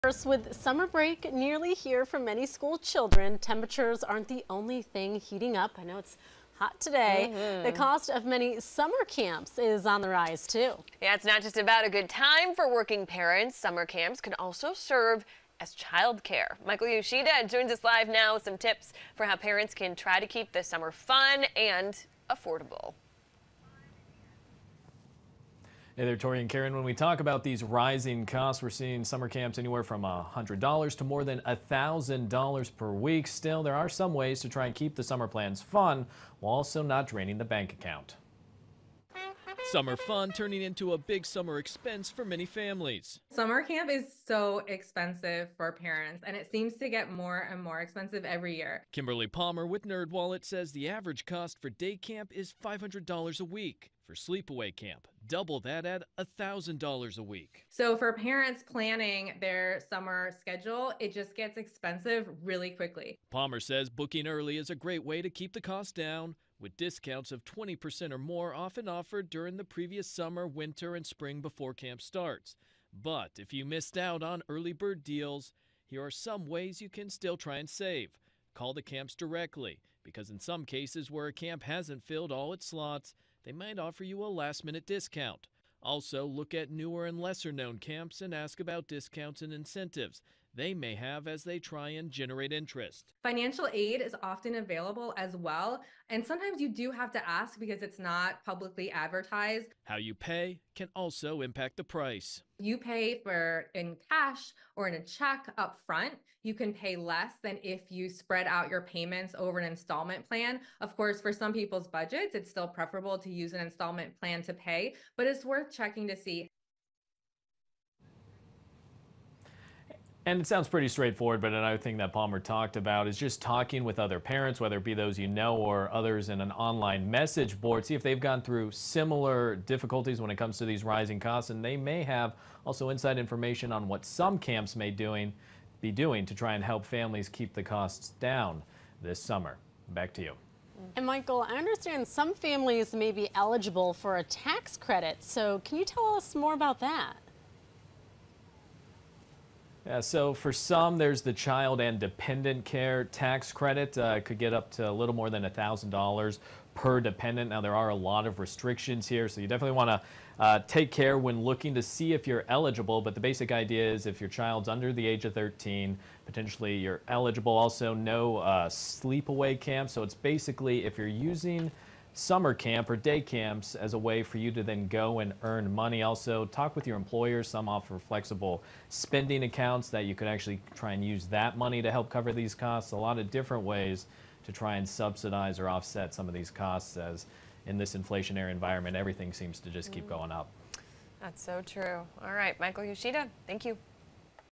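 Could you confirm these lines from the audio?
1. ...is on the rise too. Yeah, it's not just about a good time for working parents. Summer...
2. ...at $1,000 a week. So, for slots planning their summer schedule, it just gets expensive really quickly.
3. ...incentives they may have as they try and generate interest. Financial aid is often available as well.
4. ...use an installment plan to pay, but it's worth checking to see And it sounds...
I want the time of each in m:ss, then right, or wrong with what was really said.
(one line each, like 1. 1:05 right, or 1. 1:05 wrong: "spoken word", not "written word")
1. 0:09 right
2. 0:55 wrong: "parents", not "slots"
3. 1:29 right
4. 1:53 right.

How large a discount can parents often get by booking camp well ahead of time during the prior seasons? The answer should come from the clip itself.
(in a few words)
20% or more.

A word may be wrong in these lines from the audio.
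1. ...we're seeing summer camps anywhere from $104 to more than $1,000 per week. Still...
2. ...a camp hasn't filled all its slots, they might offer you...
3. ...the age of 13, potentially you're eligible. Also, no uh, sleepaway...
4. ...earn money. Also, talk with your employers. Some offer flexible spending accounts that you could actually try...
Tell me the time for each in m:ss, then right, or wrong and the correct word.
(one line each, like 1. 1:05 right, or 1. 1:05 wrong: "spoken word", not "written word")
1. 0:28 wrong: "100", not "104"
2. 1:21 right
3. 2:44 right
4. 2:55 right.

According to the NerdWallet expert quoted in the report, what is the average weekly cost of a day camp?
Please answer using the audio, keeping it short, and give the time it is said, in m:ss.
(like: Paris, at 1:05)
$500, at 0:52.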